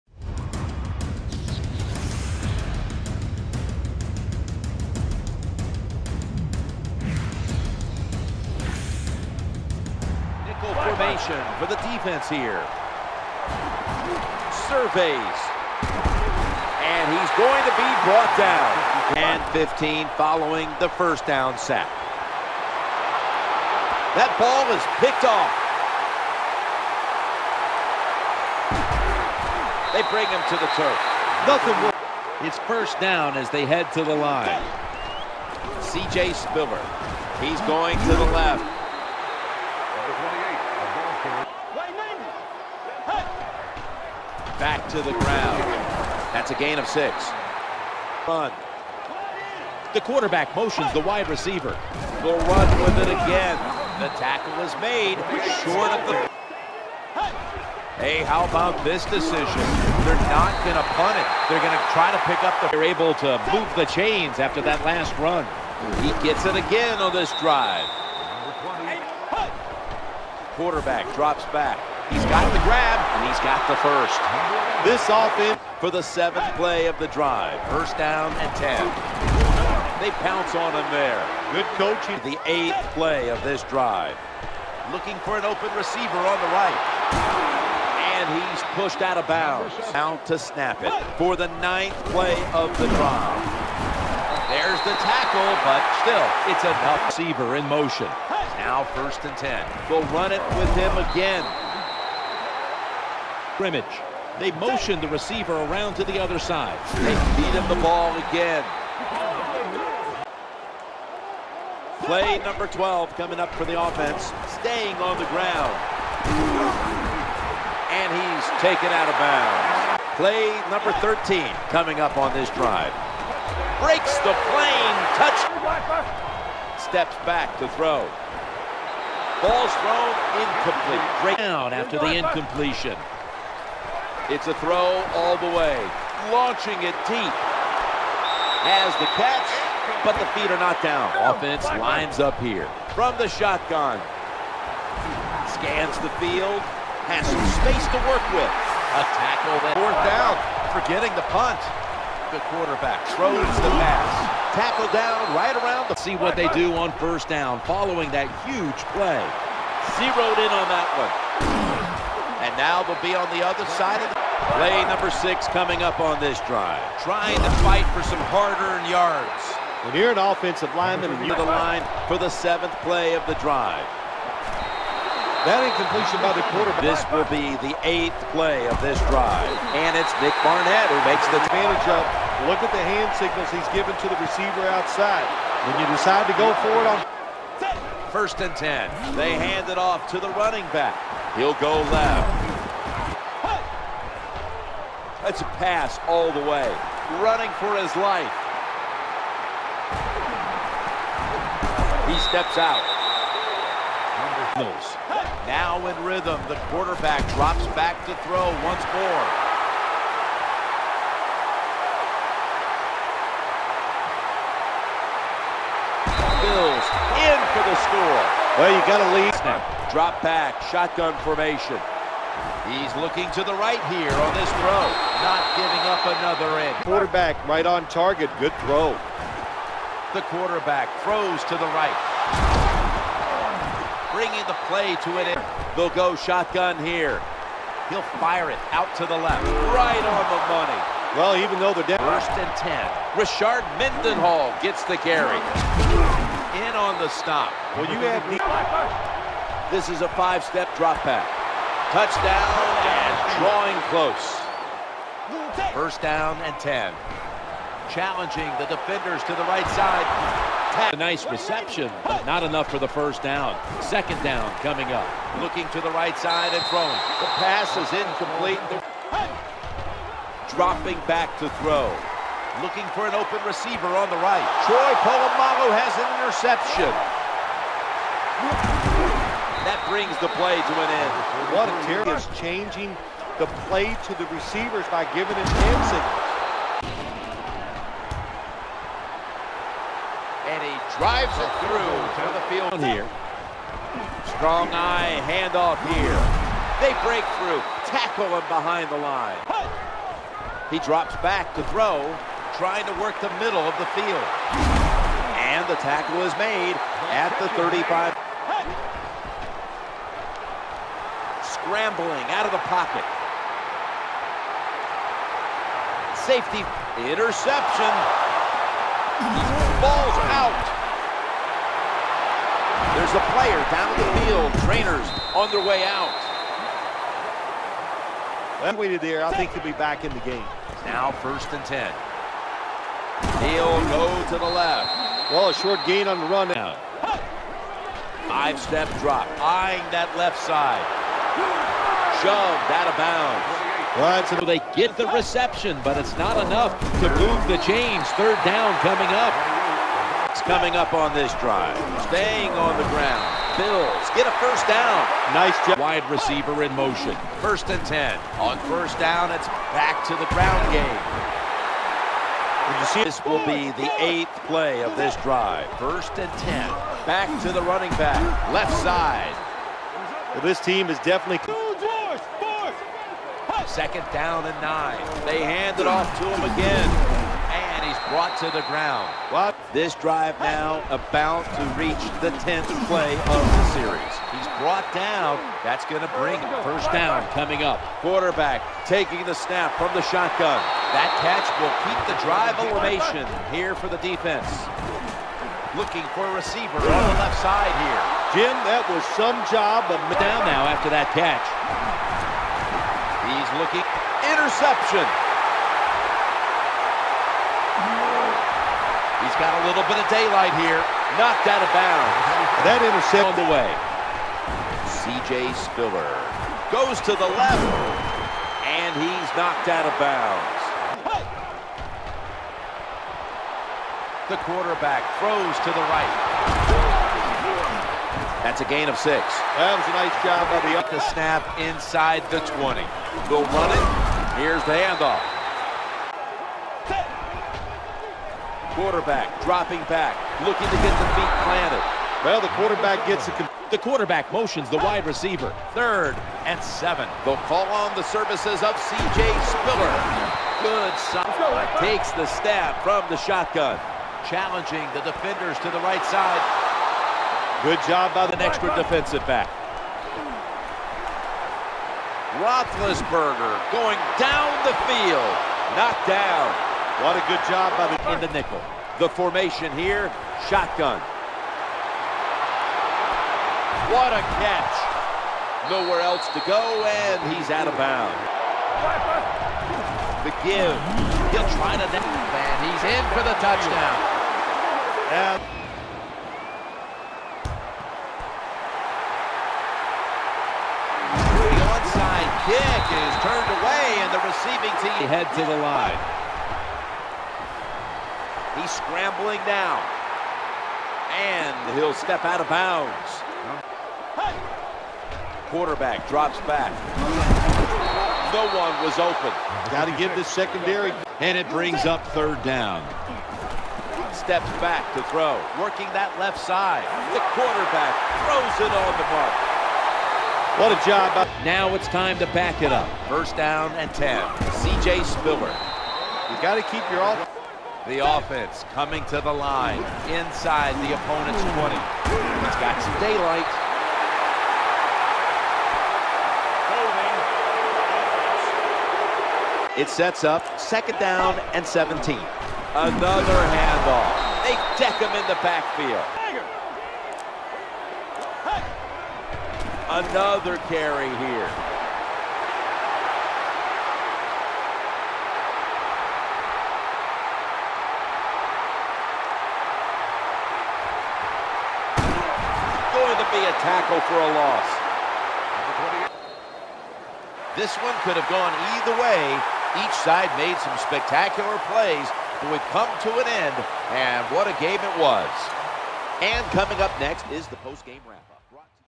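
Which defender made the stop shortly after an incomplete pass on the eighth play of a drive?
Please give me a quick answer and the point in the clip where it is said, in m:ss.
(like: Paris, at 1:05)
Nick Barnett, at 3:00.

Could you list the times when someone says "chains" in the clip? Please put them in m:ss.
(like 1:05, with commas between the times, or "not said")
1:03, 5:47.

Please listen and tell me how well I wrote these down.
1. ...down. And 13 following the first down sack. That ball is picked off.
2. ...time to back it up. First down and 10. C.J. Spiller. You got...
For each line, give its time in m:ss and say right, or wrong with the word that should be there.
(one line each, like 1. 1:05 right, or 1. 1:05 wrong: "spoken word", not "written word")
1. 0:18 wrong: "15", not "13"
2. 8:41 right.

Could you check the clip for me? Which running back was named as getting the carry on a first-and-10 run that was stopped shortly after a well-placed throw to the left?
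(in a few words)
Rashard Mendenhall.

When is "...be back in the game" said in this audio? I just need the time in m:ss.
5:29.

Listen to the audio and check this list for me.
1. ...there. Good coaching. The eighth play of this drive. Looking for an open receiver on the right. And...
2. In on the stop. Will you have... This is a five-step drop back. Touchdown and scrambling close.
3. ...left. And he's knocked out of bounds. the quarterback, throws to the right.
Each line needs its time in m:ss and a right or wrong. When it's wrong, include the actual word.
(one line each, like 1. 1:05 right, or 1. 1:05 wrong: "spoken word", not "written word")
1. 1:20 right
2. 4:06 wrong: "drawing", not "scrambling"
3. 6:57 right.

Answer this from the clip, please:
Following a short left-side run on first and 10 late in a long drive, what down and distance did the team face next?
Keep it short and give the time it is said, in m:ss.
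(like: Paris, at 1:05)
Second and 9, at 6:13.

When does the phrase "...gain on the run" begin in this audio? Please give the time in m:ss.
5:35.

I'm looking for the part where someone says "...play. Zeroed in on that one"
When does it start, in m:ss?
2:38.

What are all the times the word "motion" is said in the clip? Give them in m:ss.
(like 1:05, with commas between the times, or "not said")
0:50, 1:37, 1:44, 5:56, 7:24.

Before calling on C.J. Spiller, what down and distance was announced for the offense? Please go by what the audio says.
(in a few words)
Third and 7.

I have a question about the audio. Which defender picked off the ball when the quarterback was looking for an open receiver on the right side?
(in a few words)
Troy Polamalu.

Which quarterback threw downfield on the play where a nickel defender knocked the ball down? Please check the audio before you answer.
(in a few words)
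Roethlisberger.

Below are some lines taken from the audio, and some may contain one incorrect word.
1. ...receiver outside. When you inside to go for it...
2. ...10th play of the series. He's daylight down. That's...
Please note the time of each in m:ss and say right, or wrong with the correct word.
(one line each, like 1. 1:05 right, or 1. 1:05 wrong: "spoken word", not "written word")
1. 3:04 wrong: "decide", not "inside"
2. 6:22 wrong: "brought", not "daylight".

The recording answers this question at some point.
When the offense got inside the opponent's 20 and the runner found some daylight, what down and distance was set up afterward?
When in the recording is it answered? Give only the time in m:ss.
9:00.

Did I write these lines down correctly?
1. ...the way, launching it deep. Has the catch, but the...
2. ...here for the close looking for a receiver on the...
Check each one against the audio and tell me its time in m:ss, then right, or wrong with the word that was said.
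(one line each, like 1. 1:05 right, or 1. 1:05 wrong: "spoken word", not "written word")
1. 2:15 right
2. 6:33 wrong: "defense", not "close".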